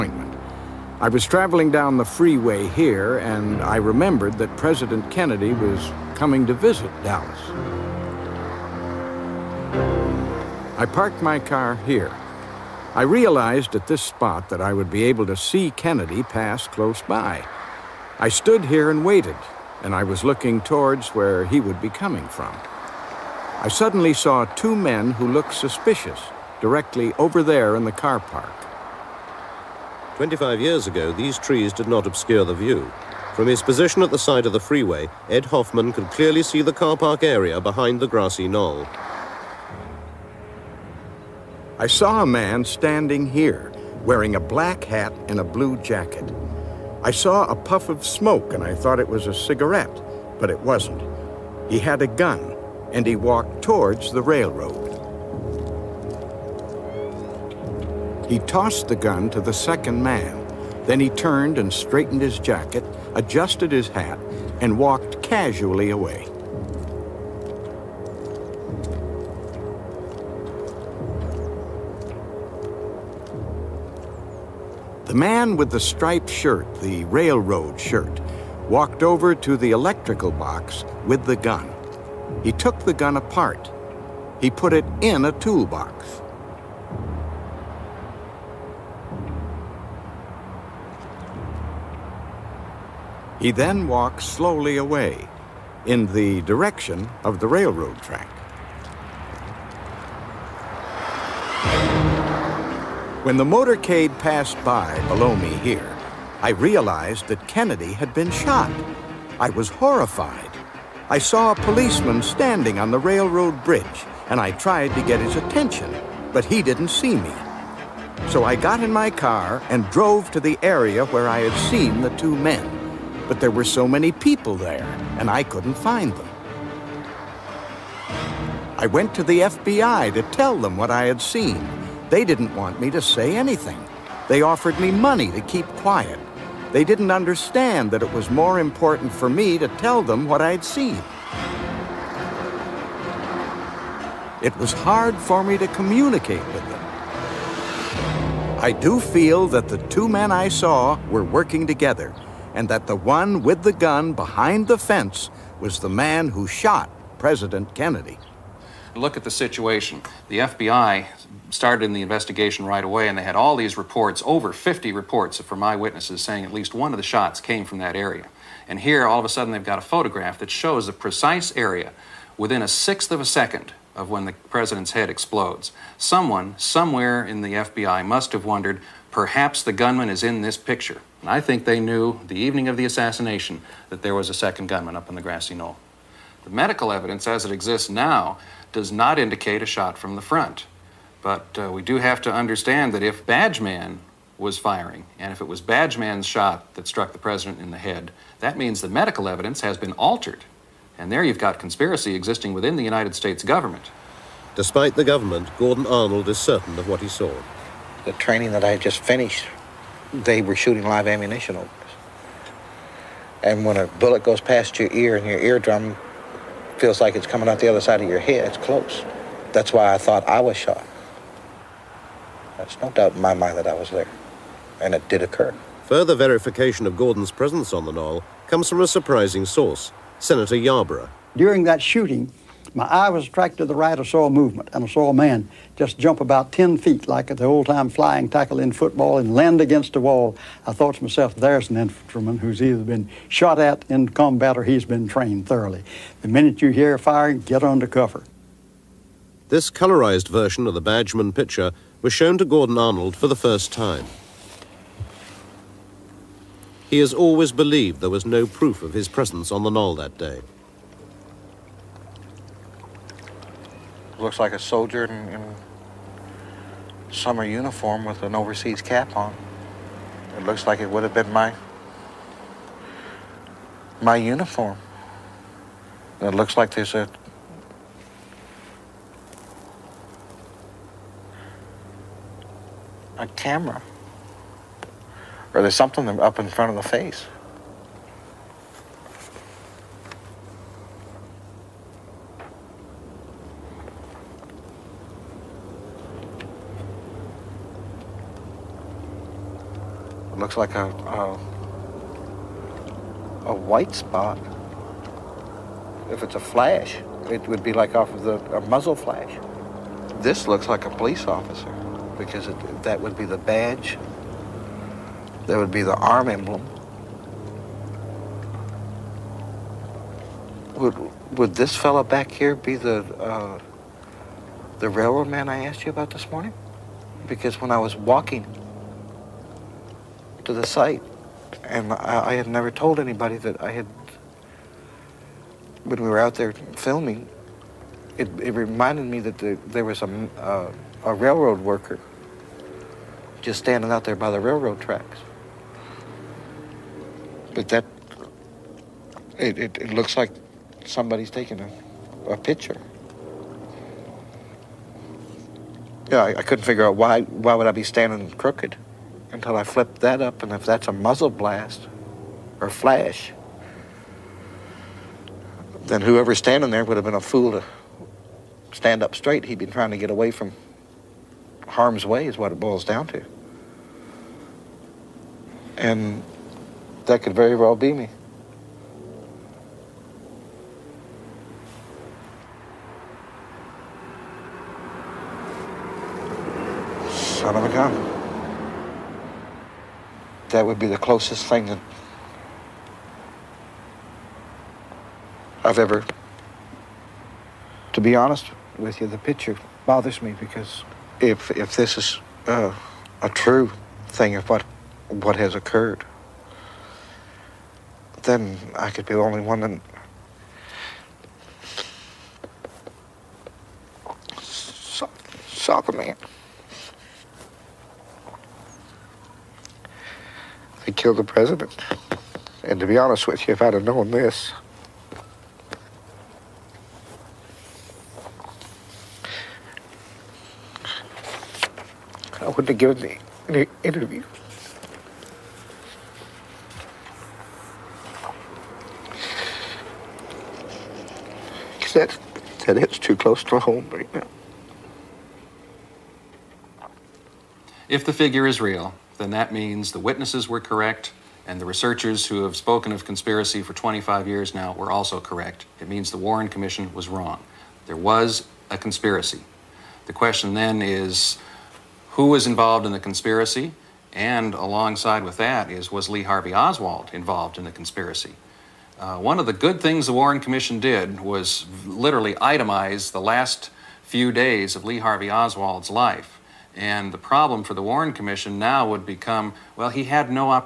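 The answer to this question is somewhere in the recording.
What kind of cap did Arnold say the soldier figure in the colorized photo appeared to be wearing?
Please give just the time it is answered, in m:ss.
4:28.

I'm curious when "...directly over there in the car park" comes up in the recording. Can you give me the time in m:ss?
0:26.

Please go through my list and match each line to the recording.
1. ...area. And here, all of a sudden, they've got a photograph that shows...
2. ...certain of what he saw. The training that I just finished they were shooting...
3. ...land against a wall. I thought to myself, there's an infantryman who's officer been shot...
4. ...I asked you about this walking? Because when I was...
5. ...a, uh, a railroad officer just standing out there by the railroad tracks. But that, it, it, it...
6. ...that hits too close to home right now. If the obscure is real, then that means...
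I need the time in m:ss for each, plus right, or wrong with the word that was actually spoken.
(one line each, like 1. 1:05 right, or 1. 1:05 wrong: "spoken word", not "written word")
1. 2:47 right
2. 3:26 right
3. 3:59 wrong: "either", not "officer"
4. 5:25 wrong: "morning", not "walking"
5. 5:40 wrong: "worker", not "officer"
6. 7:22 wrong: "figure", not "obscure".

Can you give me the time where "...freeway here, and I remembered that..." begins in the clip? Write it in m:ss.
0:02.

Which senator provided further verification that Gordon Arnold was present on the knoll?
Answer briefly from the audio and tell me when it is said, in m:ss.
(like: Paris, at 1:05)
Senator Yarborough, at 3:50.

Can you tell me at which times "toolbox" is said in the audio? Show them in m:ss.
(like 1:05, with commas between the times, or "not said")
1:25.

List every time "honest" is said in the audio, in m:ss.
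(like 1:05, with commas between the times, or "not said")
6:38, 7:02.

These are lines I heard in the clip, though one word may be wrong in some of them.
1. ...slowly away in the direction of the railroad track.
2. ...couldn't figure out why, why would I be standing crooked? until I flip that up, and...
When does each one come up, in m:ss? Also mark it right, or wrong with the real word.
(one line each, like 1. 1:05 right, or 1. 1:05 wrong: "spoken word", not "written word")
1. 1:34 right
2. 5:56 right.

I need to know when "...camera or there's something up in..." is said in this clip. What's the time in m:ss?
4:43.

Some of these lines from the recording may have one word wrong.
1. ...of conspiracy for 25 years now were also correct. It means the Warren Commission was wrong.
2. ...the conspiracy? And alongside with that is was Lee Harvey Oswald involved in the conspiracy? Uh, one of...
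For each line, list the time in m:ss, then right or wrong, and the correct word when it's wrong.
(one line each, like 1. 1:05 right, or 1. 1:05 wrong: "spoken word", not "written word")
1. 7:32 right
2. 7:42 right.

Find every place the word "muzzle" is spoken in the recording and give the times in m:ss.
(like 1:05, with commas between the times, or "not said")
5:08, 6:00.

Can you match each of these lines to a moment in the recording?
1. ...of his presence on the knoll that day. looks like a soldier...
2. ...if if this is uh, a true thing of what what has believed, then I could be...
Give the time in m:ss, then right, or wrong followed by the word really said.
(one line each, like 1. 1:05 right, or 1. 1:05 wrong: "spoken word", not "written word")
1. 4:18 right
2. 6:41 wrong: "occurred", not "believed".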